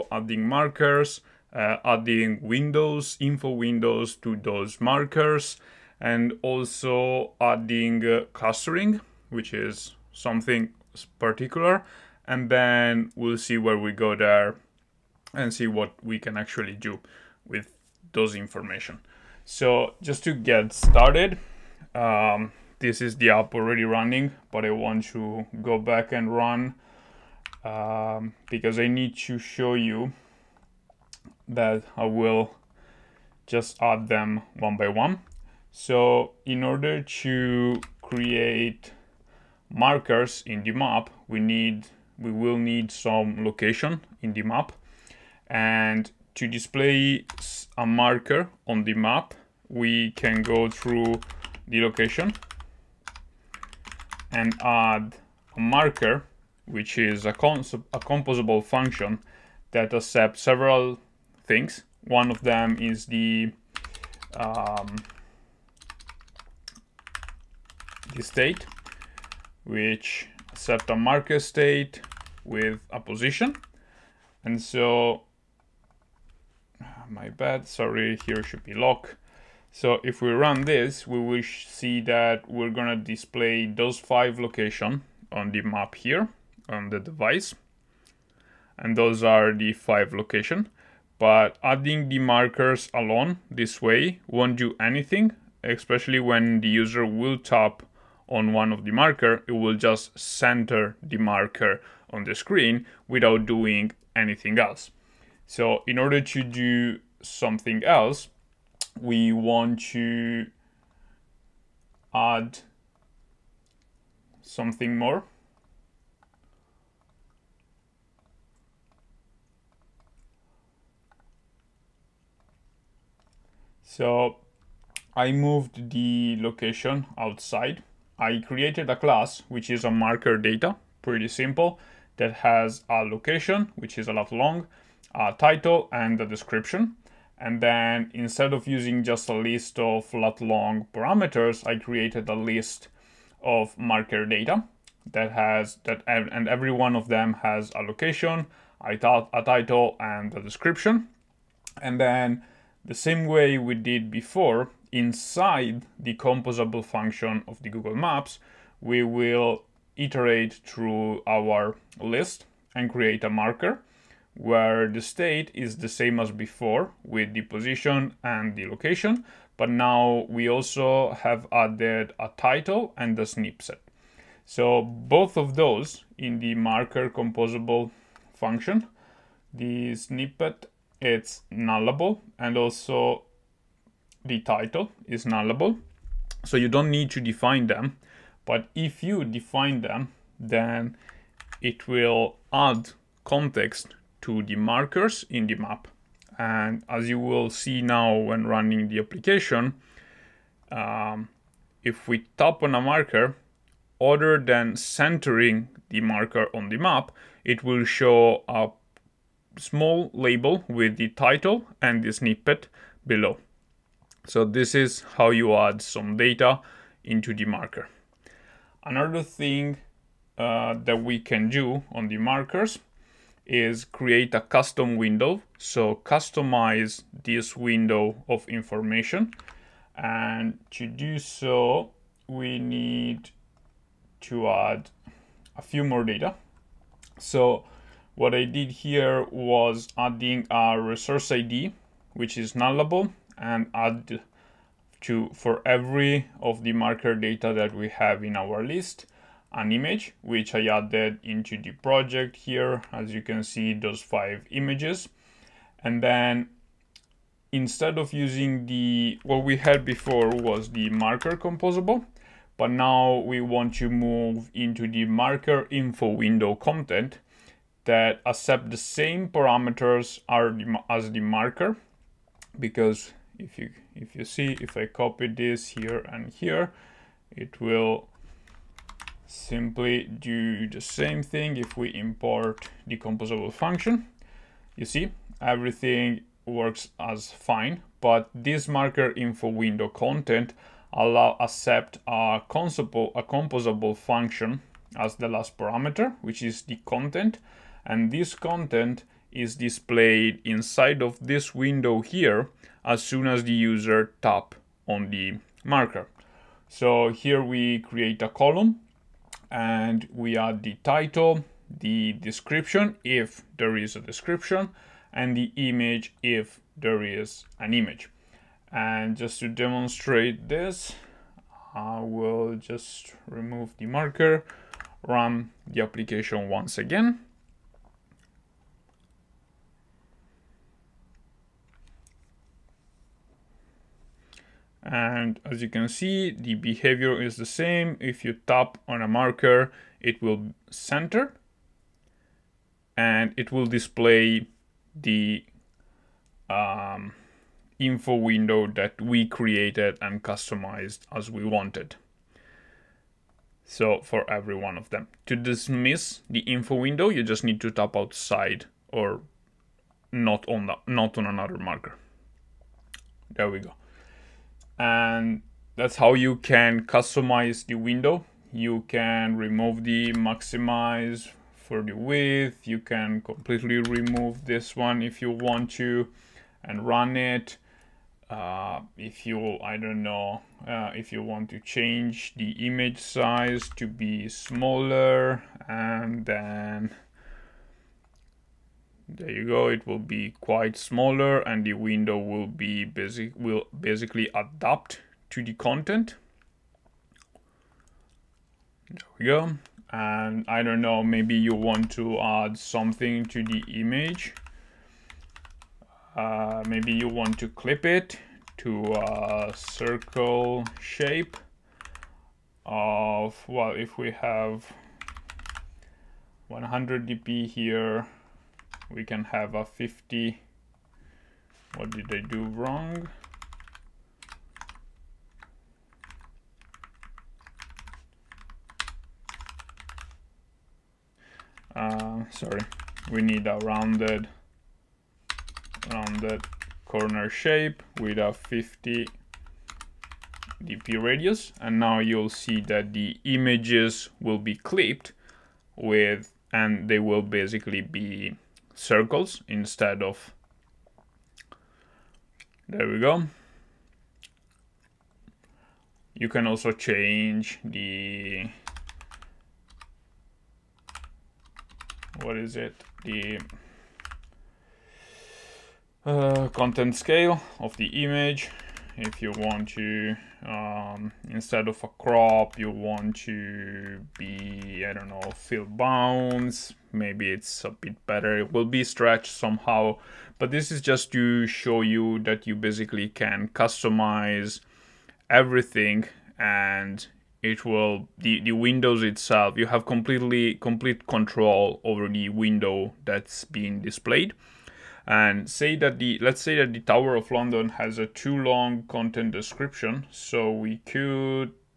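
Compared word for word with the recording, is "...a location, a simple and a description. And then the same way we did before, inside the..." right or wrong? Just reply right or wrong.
wrong.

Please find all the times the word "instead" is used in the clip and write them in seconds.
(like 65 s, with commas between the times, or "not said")
138 s, 257 s, 449 s, 471 s.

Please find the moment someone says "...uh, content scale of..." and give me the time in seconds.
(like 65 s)
466 s.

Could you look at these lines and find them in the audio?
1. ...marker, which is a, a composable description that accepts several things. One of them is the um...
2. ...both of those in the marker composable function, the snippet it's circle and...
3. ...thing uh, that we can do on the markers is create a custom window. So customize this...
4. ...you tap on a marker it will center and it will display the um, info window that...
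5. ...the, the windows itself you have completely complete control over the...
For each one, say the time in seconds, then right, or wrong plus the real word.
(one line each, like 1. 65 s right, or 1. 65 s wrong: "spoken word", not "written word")
1. 55 s wrong: "function", not "description"
2. 174 s wrong: "nullable", not "circle"
3. 219 s right
4. 338 s right
5. 488 s right.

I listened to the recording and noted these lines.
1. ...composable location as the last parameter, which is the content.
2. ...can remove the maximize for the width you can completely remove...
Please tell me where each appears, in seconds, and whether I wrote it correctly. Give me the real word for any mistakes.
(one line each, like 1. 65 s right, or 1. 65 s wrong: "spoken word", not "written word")
1. 293 s wrong: "function", not "location"
2. 368 s right.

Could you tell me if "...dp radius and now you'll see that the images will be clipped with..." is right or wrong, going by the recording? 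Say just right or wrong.
right.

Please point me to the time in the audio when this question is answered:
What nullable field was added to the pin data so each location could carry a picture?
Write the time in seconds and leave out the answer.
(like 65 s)
240 s.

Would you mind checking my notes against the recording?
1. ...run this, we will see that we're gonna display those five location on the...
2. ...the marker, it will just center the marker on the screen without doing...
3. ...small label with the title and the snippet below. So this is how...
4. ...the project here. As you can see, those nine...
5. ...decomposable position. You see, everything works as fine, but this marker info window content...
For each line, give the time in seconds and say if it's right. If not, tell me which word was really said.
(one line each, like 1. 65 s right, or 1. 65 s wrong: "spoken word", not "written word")
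1. 80 s right
2. 98 s right
3. 209 s right
4. 251 s wrong: "five", not "nine"
5. 282 s wrong: "function", not "position".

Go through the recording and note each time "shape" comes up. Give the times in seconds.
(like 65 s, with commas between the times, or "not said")
410 s, 437 s.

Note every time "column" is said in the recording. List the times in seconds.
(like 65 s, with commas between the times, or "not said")
308 s.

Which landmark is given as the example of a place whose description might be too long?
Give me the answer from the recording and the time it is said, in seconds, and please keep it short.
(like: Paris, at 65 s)
Tower of London, at 496 s.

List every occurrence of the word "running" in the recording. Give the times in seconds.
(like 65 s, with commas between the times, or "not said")
23 s, 198 s.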